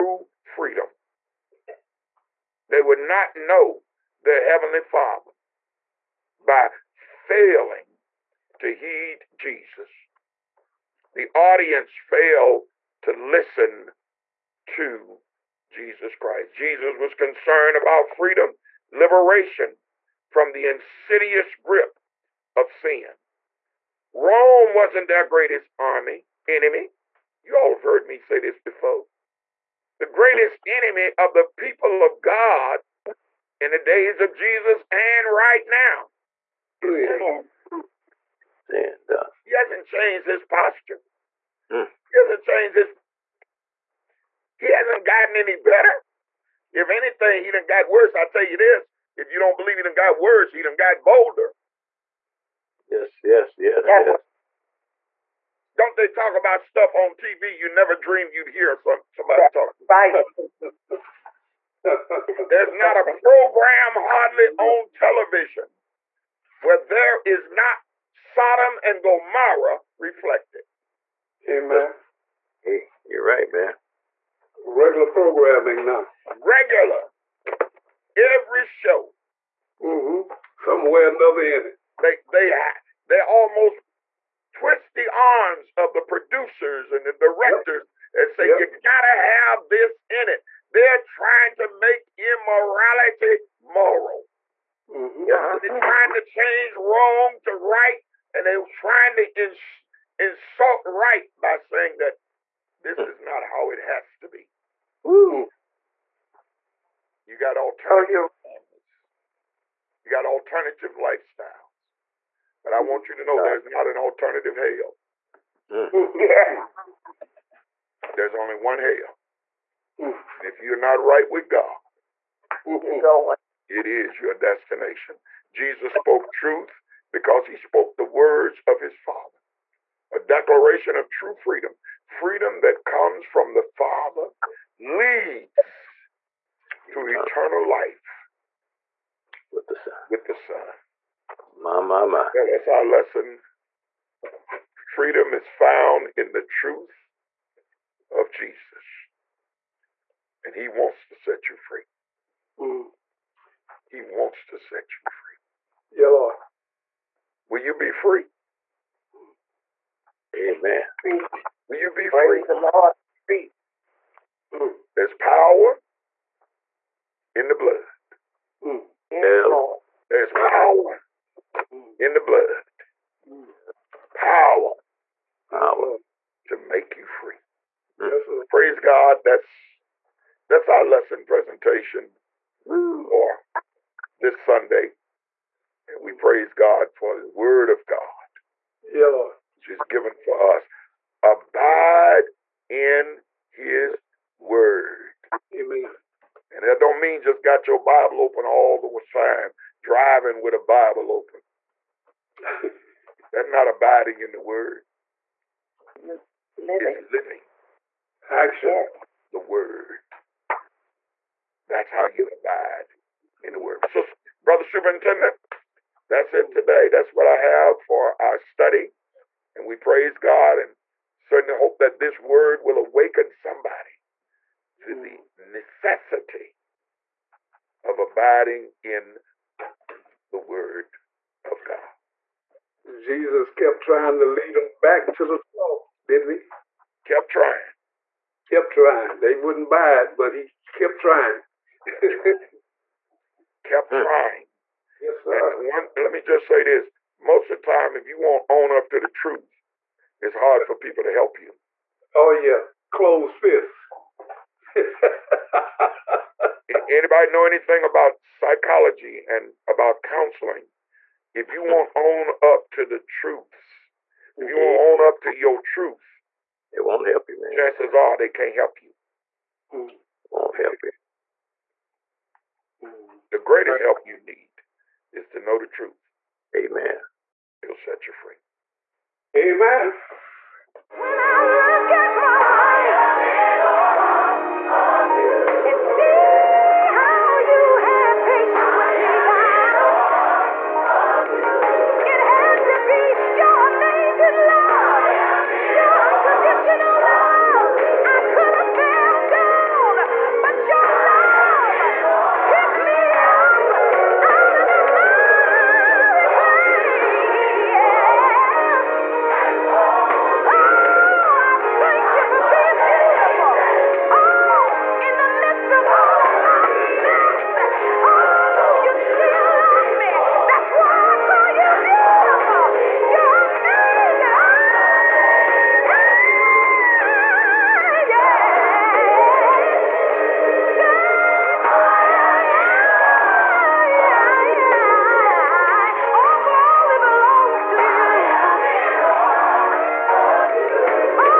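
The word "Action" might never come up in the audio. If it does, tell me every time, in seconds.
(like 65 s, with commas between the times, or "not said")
208 s.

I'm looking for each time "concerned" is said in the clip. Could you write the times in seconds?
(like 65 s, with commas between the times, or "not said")
17 s.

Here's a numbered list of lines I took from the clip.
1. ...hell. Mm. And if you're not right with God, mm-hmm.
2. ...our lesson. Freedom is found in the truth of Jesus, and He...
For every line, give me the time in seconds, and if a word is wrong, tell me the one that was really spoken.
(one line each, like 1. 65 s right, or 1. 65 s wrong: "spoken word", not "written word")
1. 118 s right
2. 142 s right.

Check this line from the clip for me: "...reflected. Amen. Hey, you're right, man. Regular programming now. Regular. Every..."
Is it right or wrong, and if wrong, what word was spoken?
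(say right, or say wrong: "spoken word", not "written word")
right.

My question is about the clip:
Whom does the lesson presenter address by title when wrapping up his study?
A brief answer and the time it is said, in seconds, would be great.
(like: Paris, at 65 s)
brother superintendent, at 214 s.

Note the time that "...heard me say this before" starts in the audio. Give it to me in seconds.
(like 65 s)
27 s.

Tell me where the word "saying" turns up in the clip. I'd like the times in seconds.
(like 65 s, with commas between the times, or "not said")
101 s.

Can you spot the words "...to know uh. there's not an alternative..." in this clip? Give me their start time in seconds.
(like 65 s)
113 s.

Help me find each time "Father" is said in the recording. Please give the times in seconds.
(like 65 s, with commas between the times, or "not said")
4 s, 128 s, 133 s.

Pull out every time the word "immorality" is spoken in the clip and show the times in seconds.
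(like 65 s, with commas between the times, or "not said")
92 s.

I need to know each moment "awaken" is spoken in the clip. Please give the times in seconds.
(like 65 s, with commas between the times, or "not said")
222 s.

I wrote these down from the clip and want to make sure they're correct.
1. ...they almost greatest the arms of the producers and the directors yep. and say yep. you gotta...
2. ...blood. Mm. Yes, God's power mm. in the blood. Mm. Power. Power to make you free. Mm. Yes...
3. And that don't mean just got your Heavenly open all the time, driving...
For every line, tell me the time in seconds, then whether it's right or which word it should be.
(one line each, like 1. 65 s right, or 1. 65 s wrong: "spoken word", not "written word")
1. 83 s wrong: "twist", not "greatest"
2. 167 s wrong: "There", not "God"
3. 196 s wrong: "Bible", not "Heavenly".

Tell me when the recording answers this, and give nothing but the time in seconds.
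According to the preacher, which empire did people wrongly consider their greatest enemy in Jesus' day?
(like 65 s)
24 s.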